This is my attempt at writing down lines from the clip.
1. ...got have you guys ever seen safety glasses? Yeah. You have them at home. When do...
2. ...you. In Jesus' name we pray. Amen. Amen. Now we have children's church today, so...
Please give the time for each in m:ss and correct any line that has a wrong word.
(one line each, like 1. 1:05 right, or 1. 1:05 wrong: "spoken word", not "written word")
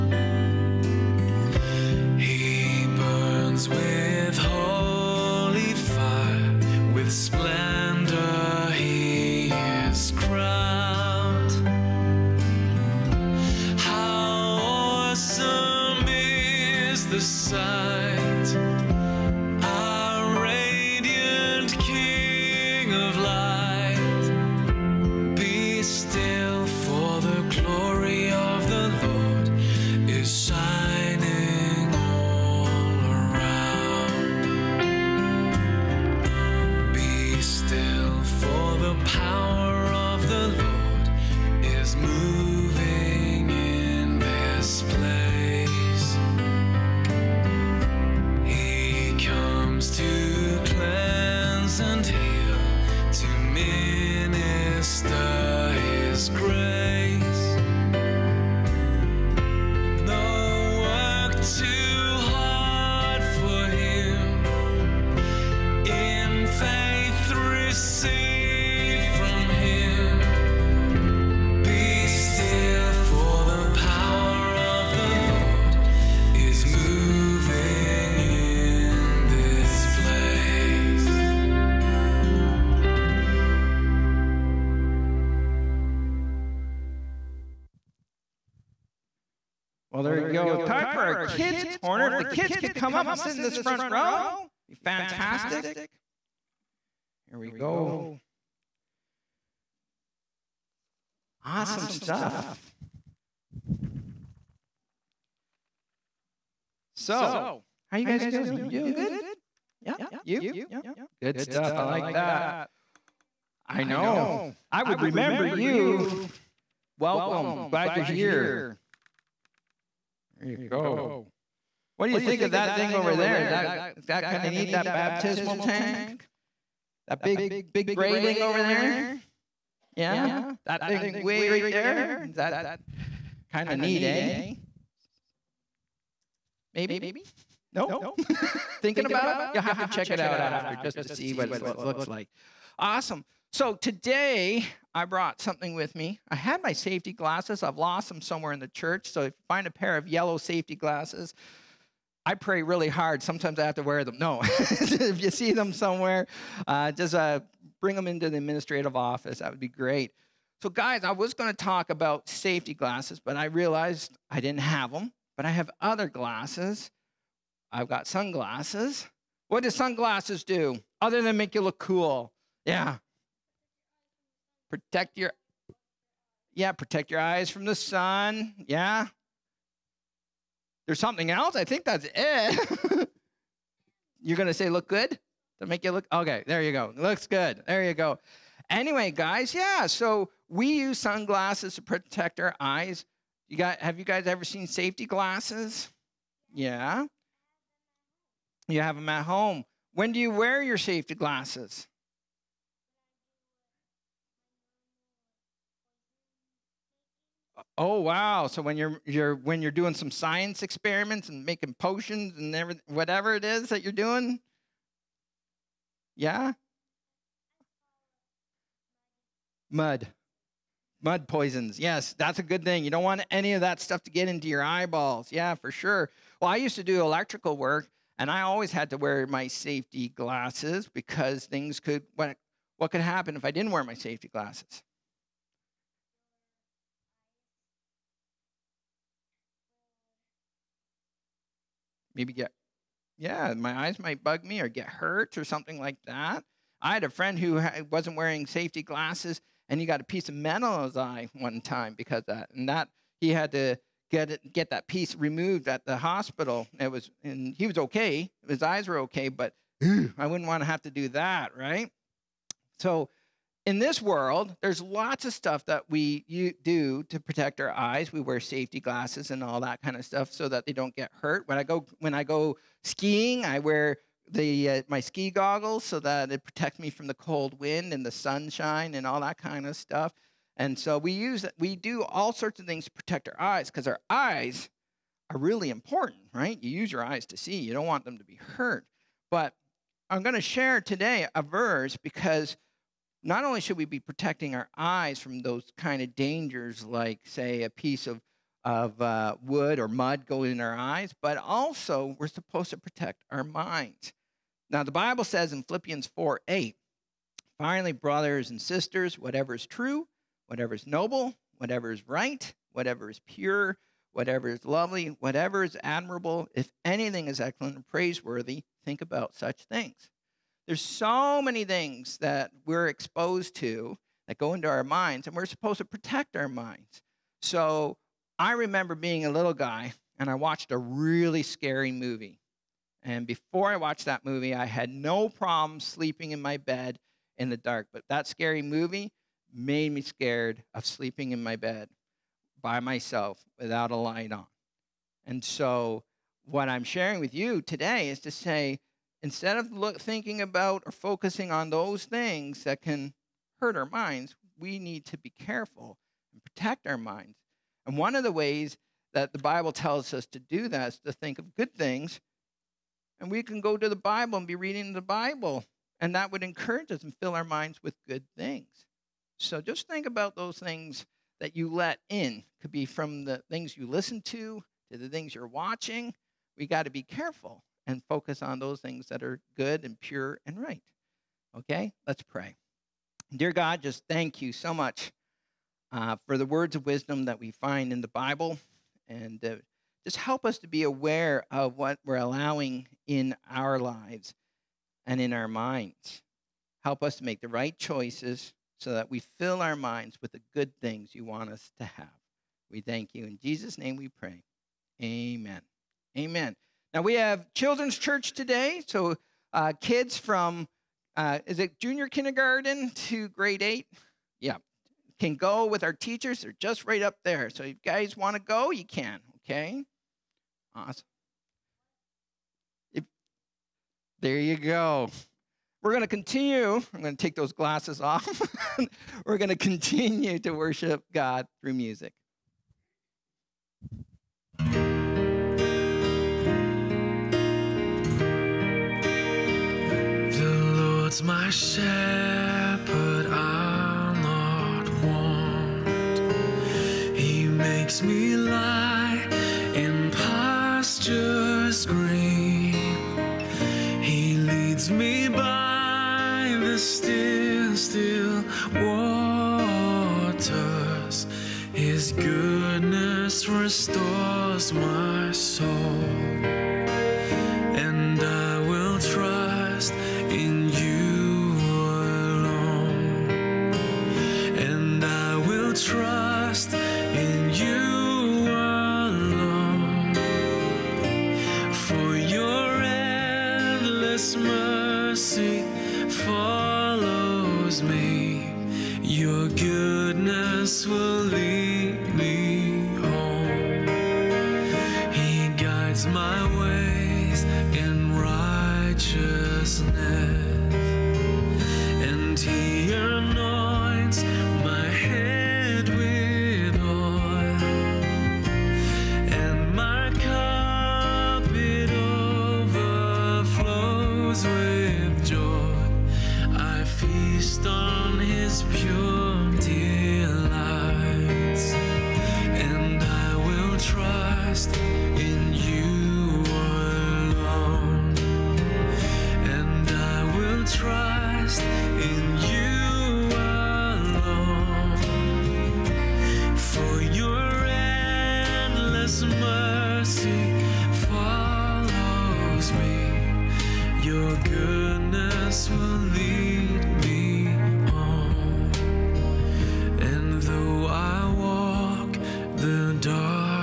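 1. 3:13 right
2. 6:43 right.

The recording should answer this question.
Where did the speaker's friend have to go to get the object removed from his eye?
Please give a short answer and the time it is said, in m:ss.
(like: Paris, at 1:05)
Hospital, at 4:15.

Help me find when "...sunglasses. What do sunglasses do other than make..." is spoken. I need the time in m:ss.
2:48.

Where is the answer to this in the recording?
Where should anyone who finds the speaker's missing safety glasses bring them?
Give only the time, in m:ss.
2:38.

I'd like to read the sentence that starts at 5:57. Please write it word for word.
And one of the ways that the Bible tells us to do that is to think of good things.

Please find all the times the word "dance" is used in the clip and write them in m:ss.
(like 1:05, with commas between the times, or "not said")
not said.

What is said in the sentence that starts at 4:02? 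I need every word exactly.
maybe get, yeah, my eyes might bug me or get hurt or something like that.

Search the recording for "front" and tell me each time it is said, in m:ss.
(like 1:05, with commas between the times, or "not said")
1:33.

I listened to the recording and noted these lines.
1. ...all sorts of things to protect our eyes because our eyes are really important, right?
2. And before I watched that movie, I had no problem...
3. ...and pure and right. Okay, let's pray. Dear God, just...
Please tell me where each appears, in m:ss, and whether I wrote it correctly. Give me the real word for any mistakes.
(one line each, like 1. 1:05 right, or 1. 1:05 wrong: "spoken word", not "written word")
1. 4:42 right
2. 5:33 right
3. 6:19 right.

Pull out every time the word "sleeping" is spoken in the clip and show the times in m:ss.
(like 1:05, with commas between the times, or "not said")
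5:35, 5:40.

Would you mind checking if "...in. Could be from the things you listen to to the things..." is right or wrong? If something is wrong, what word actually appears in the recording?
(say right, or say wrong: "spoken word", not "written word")
right.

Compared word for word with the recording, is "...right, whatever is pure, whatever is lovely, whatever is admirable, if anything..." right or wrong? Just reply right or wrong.
right.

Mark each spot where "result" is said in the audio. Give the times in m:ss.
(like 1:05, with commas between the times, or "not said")
not said.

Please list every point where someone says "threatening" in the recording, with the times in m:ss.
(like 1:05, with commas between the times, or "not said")
not said.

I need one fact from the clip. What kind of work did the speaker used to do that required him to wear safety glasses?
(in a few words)
Electrical work.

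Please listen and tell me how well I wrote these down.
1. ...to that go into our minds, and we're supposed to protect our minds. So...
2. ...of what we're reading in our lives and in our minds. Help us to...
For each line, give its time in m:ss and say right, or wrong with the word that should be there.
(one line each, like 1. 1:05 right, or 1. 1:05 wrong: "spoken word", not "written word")
1. 5:23 right
2. 6:31 wrong: "allowing", not "reading".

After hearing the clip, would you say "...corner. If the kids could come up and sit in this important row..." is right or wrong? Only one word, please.
wrong.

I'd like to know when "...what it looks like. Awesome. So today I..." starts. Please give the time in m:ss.
2:21.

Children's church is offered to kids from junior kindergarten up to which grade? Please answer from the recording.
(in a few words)
Grade 8.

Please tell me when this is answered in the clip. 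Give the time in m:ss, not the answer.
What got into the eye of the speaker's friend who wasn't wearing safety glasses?
4:10.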